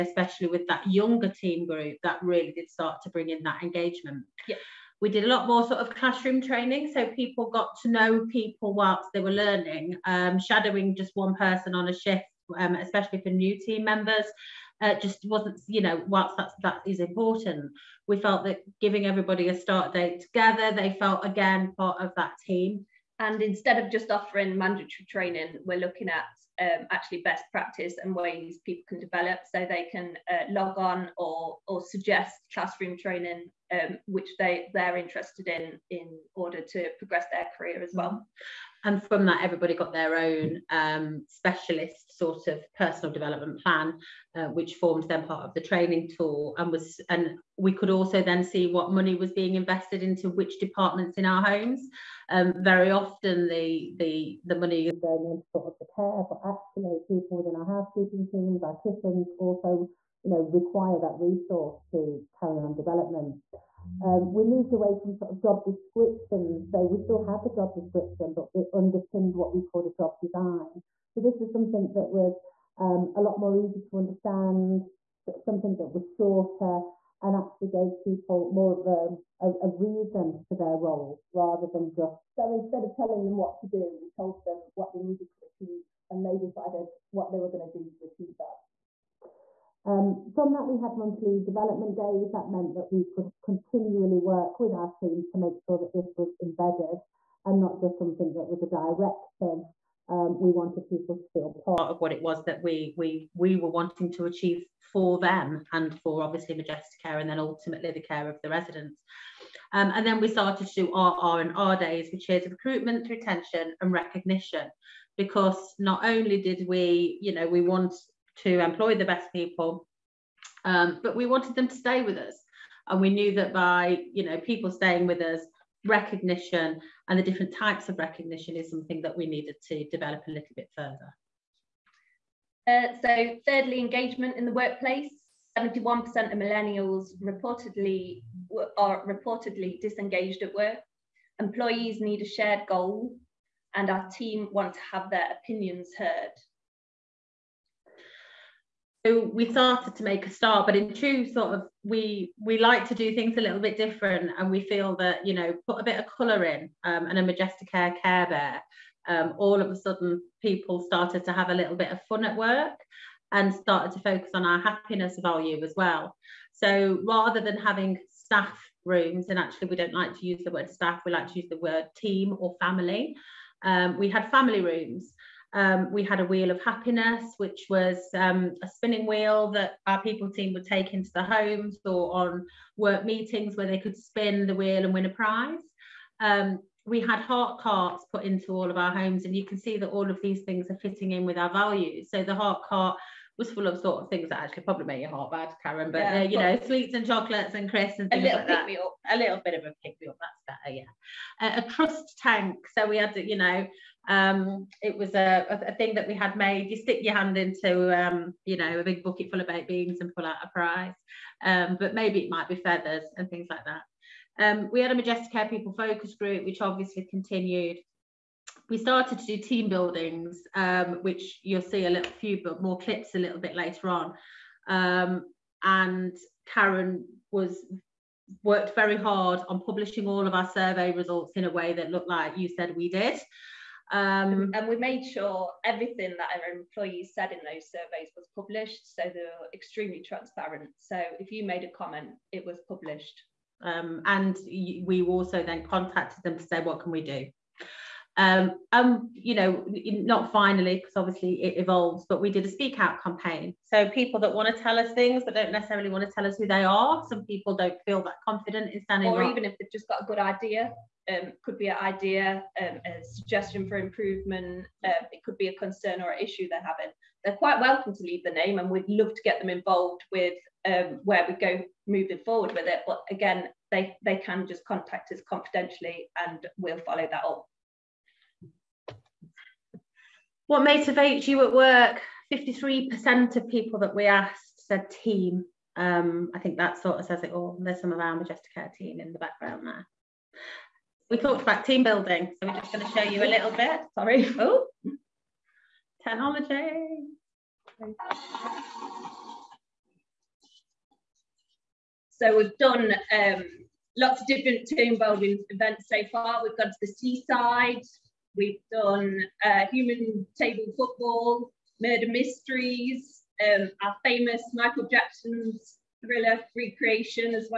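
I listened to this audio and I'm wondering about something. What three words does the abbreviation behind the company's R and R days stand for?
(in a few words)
recruitment, retention, and recognition.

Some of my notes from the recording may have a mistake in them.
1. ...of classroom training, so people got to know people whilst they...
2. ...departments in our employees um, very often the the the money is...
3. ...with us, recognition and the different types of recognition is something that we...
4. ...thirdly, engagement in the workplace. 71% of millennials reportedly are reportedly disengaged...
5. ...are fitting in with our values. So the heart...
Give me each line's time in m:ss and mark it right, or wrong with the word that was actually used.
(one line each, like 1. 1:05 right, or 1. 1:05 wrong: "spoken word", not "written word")
1. 0:05 right
2. 0:50 wrong: "homes", not "employees"
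3. 2:05 right
4. 2:13 right
5. 3:10 right.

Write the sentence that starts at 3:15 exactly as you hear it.
But yeah, uh, you know, sweets and chocolates and crisps and things a little like that.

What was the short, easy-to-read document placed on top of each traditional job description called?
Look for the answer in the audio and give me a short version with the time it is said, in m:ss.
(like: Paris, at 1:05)
job design, at 1:09.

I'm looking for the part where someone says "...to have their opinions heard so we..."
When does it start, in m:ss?
2:24.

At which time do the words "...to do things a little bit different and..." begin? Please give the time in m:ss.
2:32.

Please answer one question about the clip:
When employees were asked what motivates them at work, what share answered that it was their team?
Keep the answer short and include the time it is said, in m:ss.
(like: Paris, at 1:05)
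53%, at 4:42.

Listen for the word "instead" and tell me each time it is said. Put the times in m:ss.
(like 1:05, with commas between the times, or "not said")
0:23, 1:22.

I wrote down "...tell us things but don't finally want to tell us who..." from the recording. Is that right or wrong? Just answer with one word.
wrong.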